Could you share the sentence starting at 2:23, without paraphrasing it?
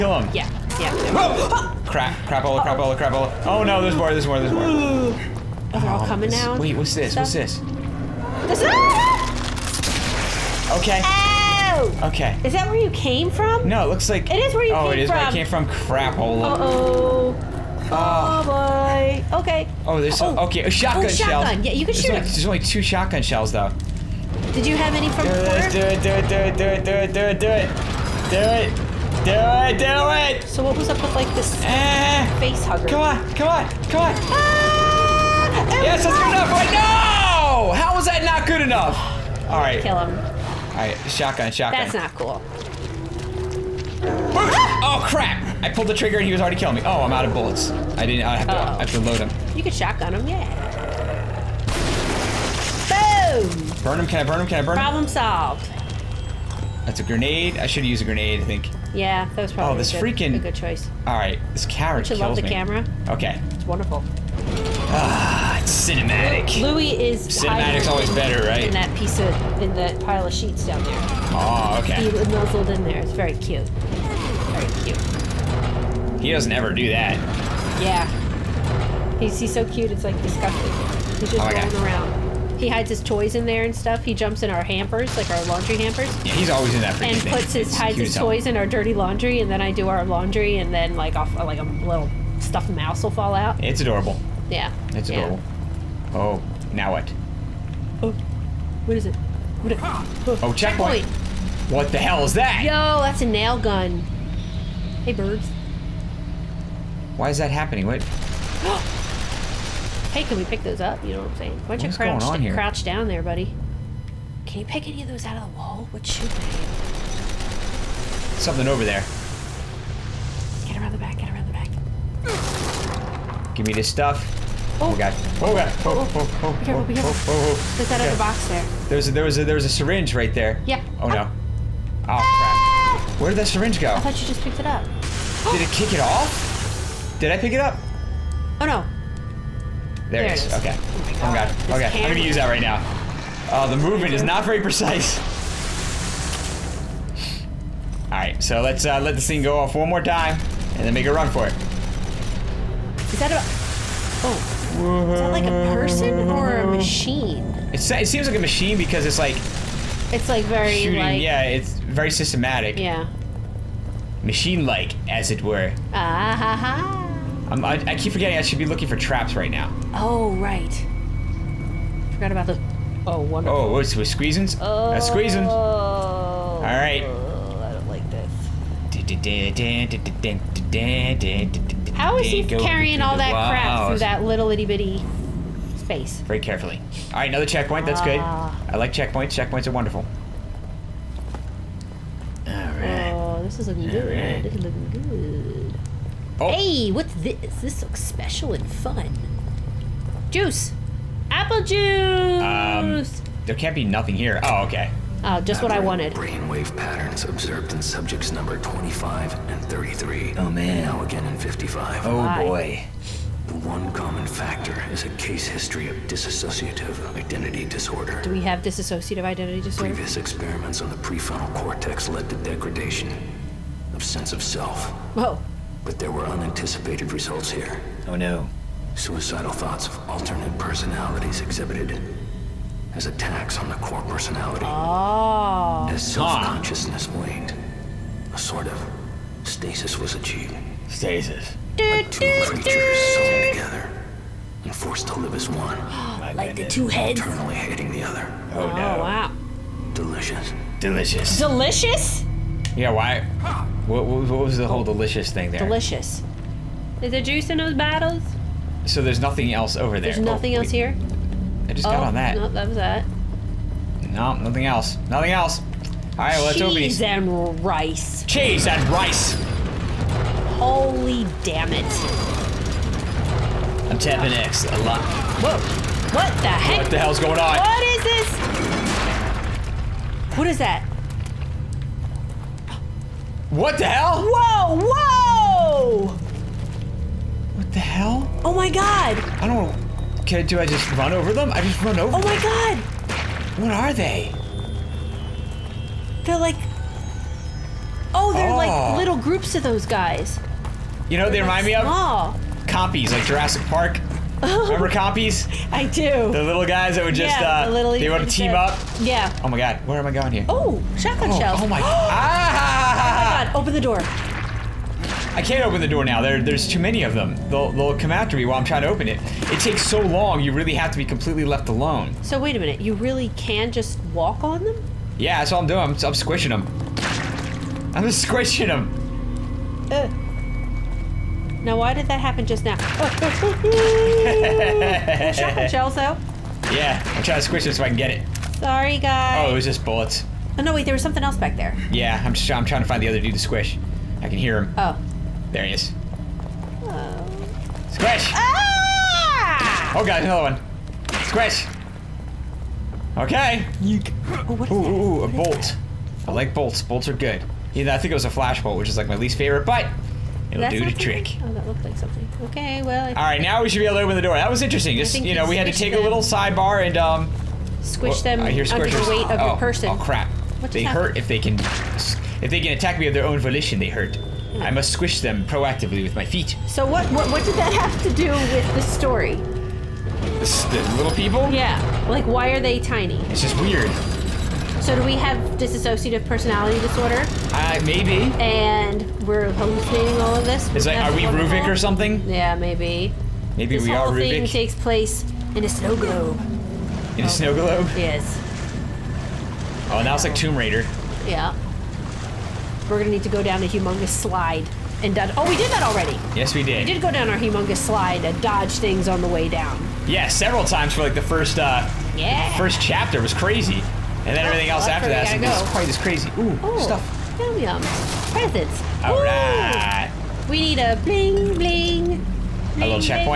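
Oh, the movement is not very precise.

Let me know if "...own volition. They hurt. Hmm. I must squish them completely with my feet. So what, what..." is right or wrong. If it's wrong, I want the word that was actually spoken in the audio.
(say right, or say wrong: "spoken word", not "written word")
wrong: "proactively", not "completely".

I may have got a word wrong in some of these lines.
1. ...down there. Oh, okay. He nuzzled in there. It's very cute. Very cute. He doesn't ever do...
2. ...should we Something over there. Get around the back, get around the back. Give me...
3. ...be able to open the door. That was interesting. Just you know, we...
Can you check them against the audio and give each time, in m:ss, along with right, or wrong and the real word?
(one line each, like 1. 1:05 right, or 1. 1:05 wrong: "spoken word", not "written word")
1. 1:10 right
2. 1:56 right
3. 6:03 right.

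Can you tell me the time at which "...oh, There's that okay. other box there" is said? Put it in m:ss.
2:07.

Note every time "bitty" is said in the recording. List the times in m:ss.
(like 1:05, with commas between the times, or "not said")
3:04.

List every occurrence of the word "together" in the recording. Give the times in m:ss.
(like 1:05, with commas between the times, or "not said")
4:03.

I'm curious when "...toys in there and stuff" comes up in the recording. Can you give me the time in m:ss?
1:23.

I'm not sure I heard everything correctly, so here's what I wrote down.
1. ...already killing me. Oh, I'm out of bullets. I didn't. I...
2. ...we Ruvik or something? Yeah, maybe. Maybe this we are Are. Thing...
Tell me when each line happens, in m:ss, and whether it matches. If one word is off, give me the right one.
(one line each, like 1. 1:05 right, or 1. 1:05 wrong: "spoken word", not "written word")
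1. 0:46 right
2. 6:31 wrong: "Ruvik", not "Are".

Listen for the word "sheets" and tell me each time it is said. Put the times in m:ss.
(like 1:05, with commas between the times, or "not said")
1:10.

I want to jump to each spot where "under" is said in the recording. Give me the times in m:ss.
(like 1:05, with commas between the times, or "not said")
6:08.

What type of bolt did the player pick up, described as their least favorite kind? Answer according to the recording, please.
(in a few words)
Flash bolt.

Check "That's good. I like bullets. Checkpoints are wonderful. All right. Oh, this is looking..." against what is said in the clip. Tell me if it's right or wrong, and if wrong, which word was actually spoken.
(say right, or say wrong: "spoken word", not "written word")
wrong: "checkpoints", not "bullets".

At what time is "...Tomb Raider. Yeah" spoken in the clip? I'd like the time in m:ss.
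6:40.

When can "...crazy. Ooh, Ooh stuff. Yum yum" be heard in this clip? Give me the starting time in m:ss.
6:55.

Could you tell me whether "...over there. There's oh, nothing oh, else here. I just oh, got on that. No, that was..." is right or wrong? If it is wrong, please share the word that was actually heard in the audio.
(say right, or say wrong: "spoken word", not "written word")
right.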